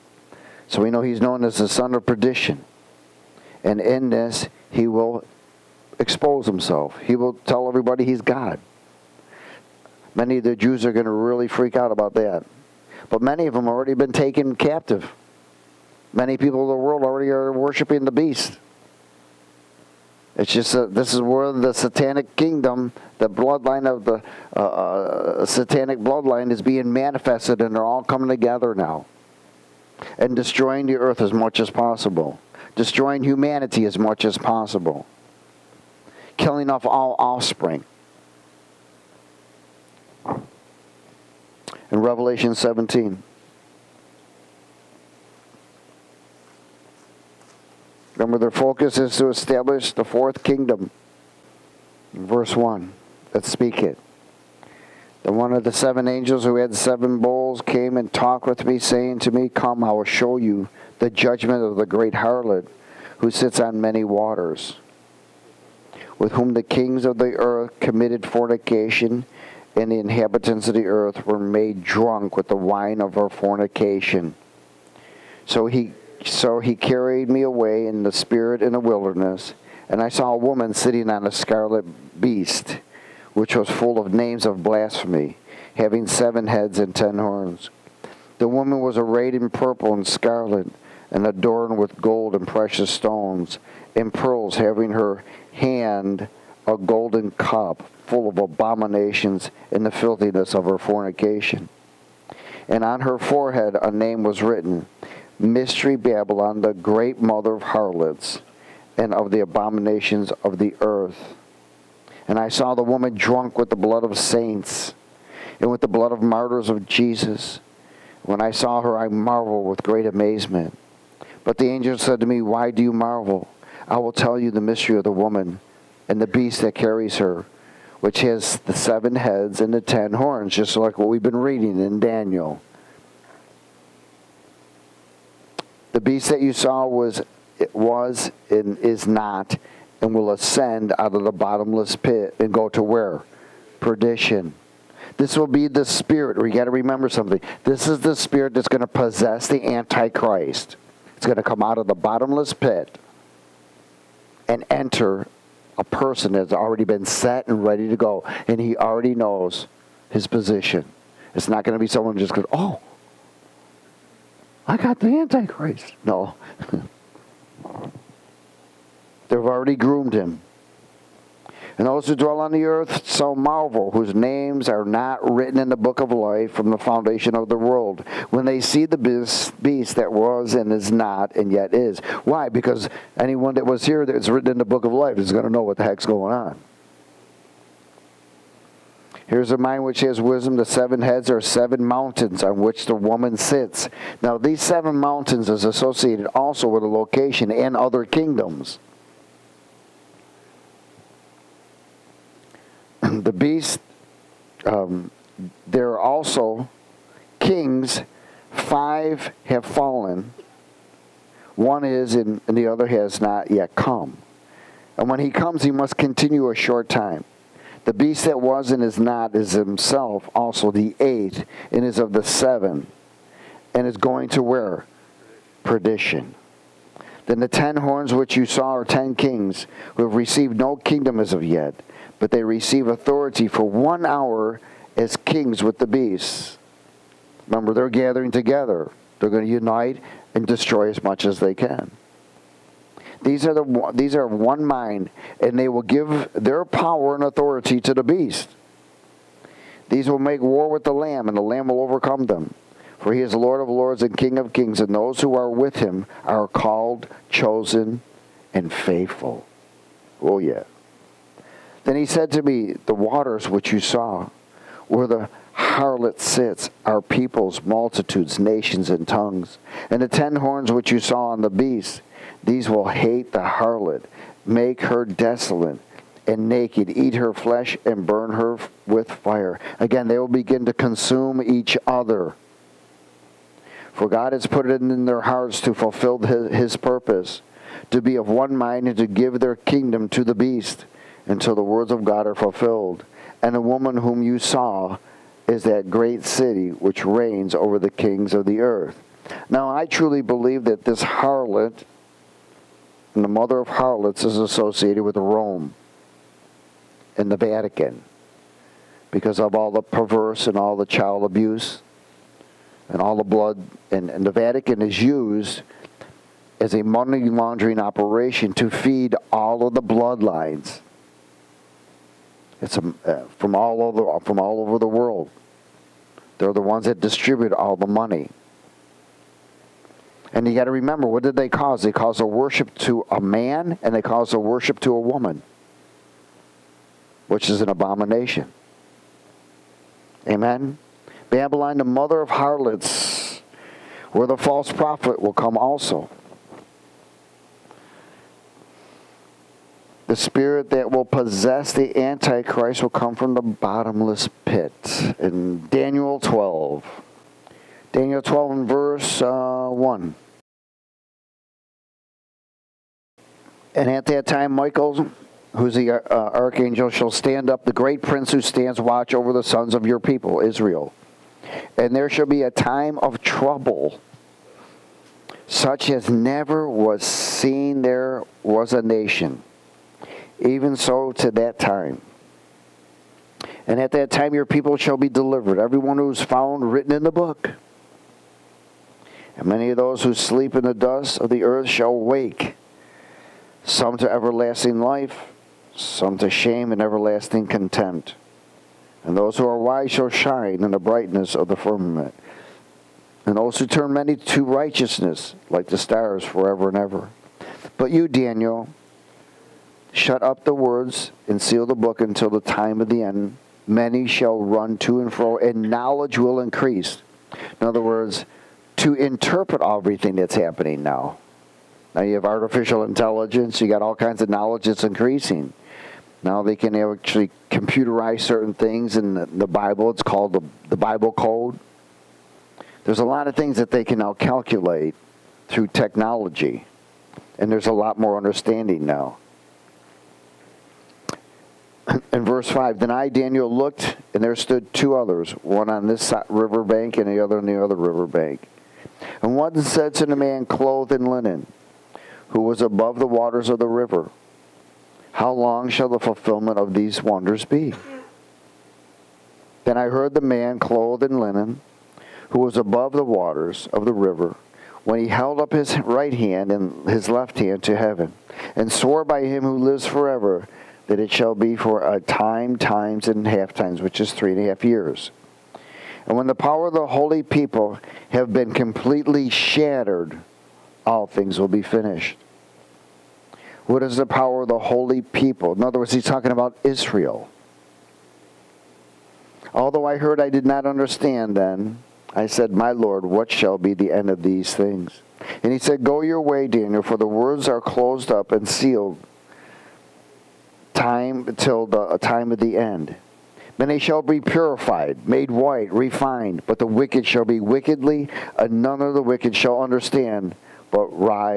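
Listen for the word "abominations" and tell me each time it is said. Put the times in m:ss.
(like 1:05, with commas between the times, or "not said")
1:38, 1:49, 5:37.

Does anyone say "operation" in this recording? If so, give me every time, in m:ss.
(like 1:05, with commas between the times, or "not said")
5:17.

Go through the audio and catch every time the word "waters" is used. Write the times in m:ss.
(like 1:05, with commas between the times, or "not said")
1:04, 4:22, 7:33, 7:43.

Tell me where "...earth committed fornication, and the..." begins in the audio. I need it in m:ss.
1:07.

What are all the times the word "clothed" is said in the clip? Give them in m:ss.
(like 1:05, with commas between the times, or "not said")
7:30, 7:40.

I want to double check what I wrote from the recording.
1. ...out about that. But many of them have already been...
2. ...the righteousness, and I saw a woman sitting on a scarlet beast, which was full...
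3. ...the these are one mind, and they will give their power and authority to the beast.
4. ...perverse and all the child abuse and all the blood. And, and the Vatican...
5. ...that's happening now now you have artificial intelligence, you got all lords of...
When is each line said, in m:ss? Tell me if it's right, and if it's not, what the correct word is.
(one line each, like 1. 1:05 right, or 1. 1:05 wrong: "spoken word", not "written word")
1. 0:11 right
2. 1:18 wrong: "wilderness", not "righteousness"
3. 4:03 right
4. 5:09 right
5. 7:00 wrong: "kinds", not "lords".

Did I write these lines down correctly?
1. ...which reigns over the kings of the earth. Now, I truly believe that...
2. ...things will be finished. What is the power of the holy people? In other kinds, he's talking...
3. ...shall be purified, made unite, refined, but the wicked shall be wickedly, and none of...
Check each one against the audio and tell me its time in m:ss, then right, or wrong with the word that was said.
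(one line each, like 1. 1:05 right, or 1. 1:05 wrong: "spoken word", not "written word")
1. 4:56 right
2. 8:01 wrong: "words", not "kinds"
3. 8:23 wrong: "white", not "unite".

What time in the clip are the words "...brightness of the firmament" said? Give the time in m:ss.
6:40.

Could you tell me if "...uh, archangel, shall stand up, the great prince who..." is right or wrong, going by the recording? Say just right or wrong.
right.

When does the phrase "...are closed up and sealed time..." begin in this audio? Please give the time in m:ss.
8:17.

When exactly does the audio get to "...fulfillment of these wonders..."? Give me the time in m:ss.
7:35.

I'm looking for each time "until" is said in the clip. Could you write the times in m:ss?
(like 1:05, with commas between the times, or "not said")
4:51, 6:52.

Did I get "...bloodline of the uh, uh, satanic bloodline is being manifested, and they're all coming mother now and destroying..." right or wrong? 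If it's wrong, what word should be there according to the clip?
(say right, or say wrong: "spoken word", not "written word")
wrong: "together", not "mother".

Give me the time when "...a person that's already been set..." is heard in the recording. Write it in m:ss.
2:35.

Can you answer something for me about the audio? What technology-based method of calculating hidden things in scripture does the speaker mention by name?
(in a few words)
the Bible Code.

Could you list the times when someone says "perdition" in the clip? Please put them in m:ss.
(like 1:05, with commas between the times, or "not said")
0:02, 2:23, 3:45.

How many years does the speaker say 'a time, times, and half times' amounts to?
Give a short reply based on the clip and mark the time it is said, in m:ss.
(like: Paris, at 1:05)
3.5, at 7:54.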